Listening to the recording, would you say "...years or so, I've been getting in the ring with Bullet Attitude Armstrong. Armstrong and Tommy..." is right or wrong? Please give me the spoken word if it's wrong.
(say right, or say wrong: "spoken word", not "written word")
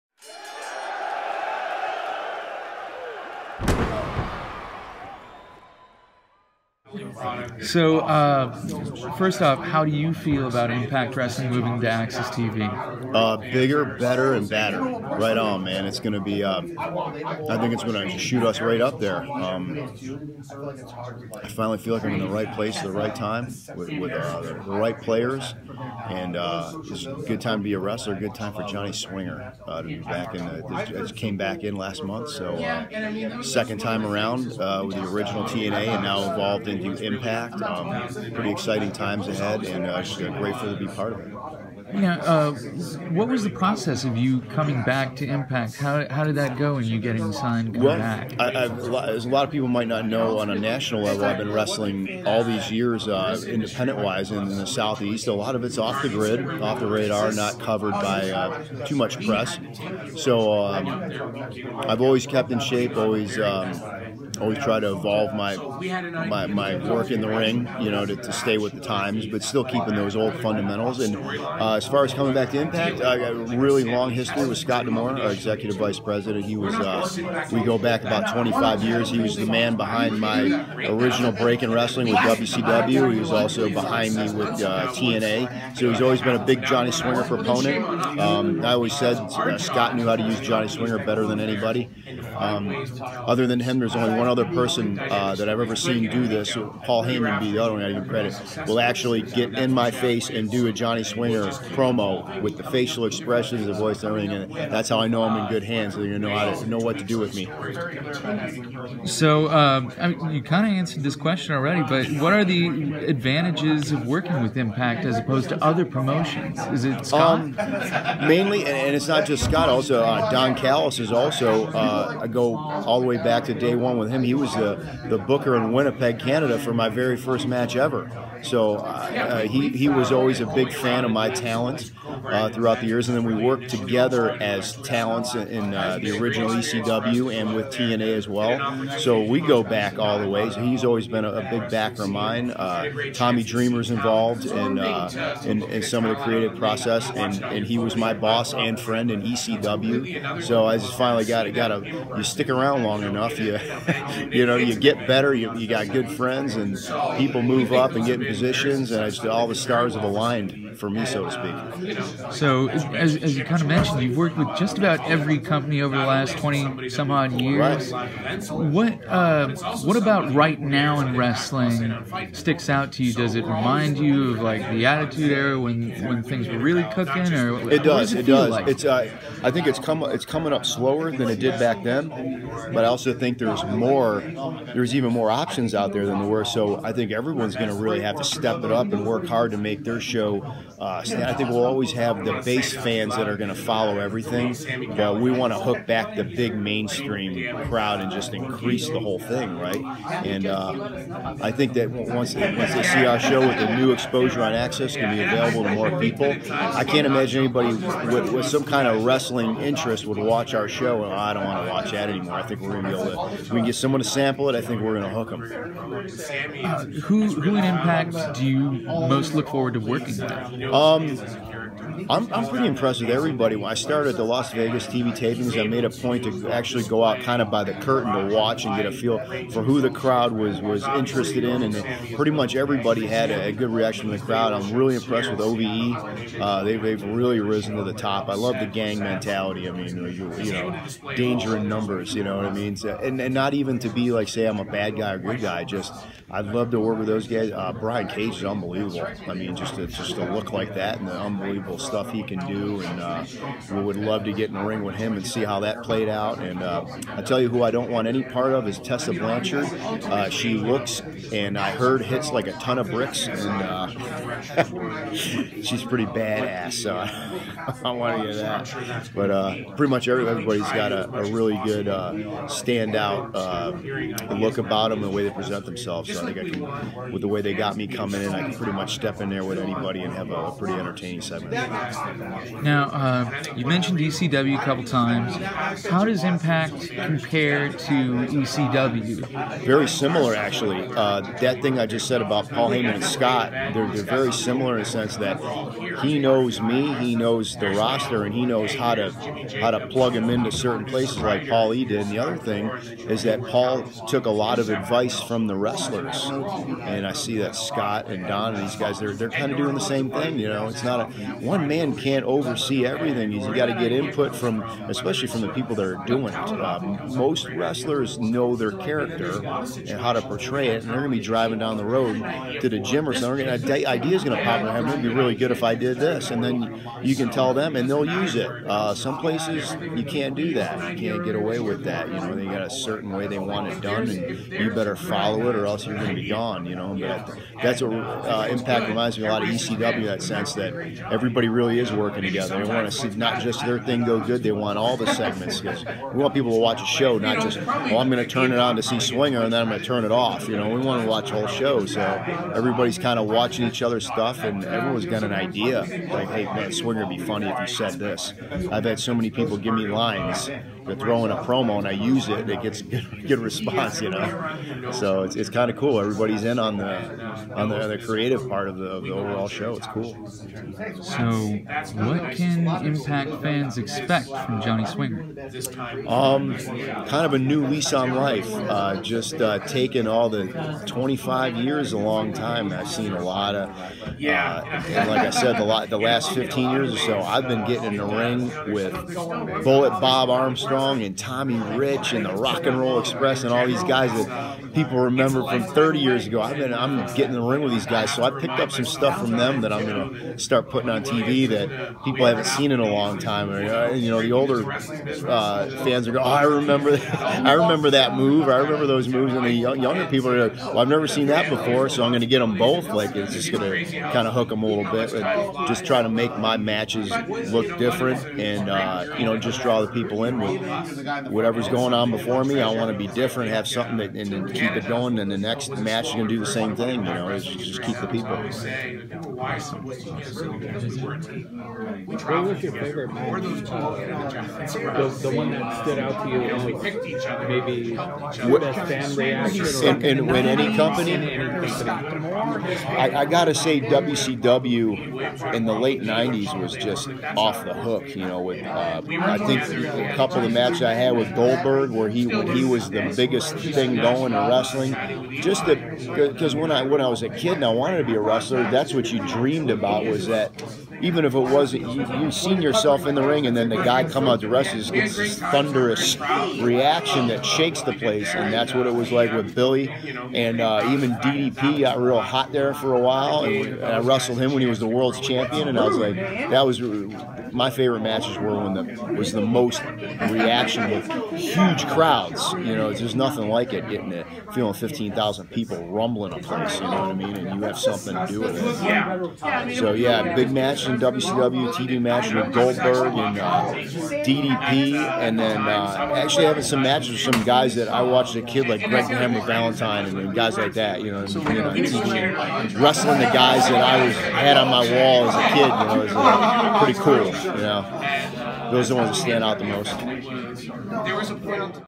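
wrong: "Bob", not "Attitude".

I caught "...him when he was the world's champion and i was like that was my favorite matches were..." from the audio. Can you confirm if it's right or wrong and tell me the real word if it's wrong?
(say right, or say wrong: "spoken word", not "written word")
right.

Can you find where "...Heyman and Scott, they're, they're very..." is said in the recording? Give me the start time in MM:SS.
04:52.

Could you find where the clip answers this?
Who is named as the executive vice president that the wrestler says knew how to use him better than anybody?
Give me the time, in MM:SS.
01:14.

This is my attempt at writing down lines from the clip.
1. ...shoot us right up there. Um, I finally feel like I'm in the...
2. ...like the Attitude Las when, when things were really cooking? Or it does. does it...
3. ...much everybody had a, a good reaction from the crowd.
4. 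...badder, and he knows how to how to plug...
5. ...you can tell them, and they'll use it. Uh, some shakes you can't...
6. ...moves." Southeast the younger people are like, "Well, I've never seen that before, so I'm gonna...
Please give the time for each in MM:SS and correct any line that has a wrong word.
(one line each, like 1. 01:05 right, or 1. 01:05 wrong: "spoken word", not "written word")
1. 00:18 right
2. 02:54 wrong: "Era", not "Las"
3. 03:52 right
4. 04:57 wrong: "roster", not "badder"
5. 05:27 wrong: "places", not "shakes"
6. 06:49 wrong: "And", not "Southeast".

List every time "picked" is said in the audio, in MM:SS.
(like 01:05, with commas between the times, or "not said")
06:38, 07:16.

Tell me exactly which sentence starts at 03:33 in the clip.
We can get someone to sample it.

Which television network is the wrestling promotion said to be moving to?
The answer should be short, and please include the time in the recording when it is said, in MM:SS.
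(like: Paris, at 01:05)
AXS TV, at 00:11.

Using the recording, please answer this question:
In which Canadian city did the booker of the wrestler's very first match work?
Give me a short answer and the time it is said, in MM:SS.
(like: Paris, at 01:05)
Winnipeg, at 02:05.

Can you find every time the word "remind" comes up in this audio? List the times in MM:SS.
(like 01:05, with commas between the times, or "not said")
02:53, 05:38.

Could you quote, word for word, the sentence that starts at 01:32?
Um, other than him, there's only one other person uh, that I've ever seen do this.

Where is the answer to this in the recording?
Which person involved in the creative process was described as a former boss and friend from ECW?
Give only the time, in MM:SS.
02:23.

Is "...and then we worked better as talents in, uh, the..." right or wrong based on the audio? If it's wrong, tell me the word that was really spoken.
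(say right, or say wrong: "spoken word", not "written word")
wrong: "together", not "better".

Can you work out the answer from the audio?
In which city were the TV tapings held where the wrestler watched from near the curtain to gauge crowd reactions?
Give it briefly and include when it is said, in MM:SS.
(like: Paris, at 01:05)
Las Vegas, at 03:44.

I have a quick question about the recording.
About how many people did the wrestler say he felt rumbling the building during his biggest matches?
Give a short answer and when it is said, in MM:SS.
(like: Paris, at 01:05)
15,000, at 08:04.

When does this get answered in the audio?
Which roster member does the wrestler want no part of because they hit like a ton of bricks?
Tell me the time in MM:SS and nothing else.
04:18.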